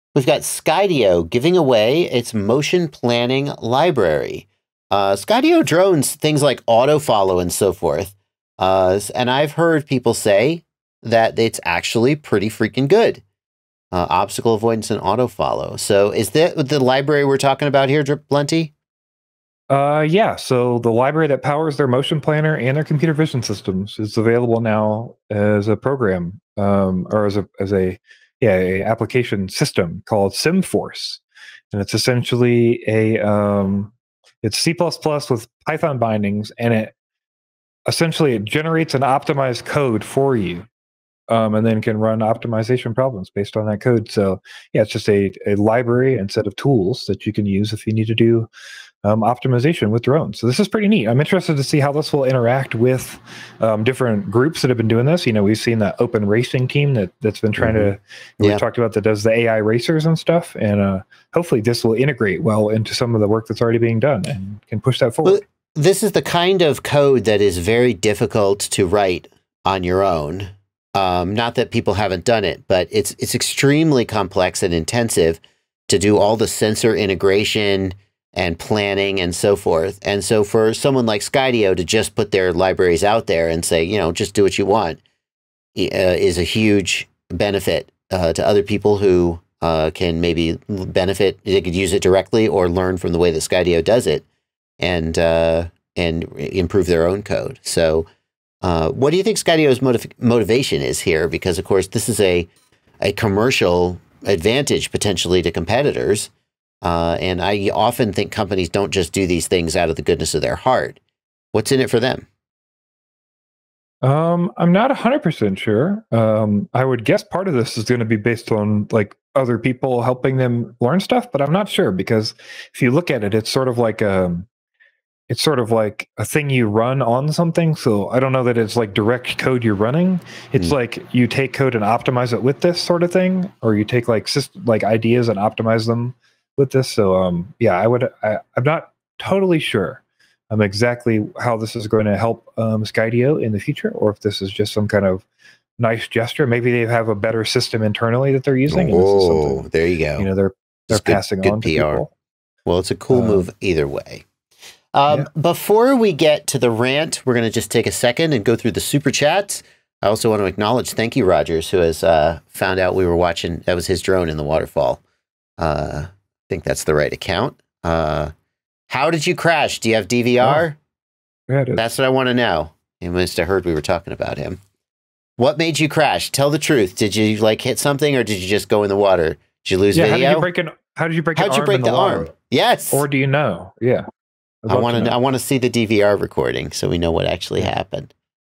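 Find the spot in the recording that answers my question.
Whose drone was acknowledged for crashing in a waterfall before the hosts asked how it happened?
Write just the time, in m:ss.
2:41.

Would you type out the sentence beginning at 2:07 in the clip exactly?
So I don't know that it's like direct code you're running.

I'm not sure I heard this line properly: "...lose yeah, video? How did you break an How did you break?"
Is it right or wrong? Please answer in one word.
right.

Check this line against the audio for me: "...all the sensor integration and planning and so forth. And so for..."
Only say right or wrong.
right.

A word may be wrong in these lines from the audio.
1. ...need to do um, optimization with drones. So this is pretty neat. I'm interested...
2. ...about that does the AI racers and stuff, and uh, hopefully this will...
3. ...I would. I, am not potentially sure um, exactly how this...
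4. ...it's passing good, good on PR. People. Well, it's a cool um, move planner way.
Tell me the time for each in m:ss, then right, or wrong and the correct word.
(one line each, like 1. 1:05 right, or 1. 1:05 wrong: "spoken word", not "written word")
1. 0:47 right
2. 0:58 right
3. 2:17 wrong: "totally", not "potentially"
4. 2:30 wrong: "either", not "planner".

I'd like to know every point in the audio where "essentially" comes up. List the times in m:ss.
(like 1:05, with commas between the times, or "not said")
0:31, 0:37.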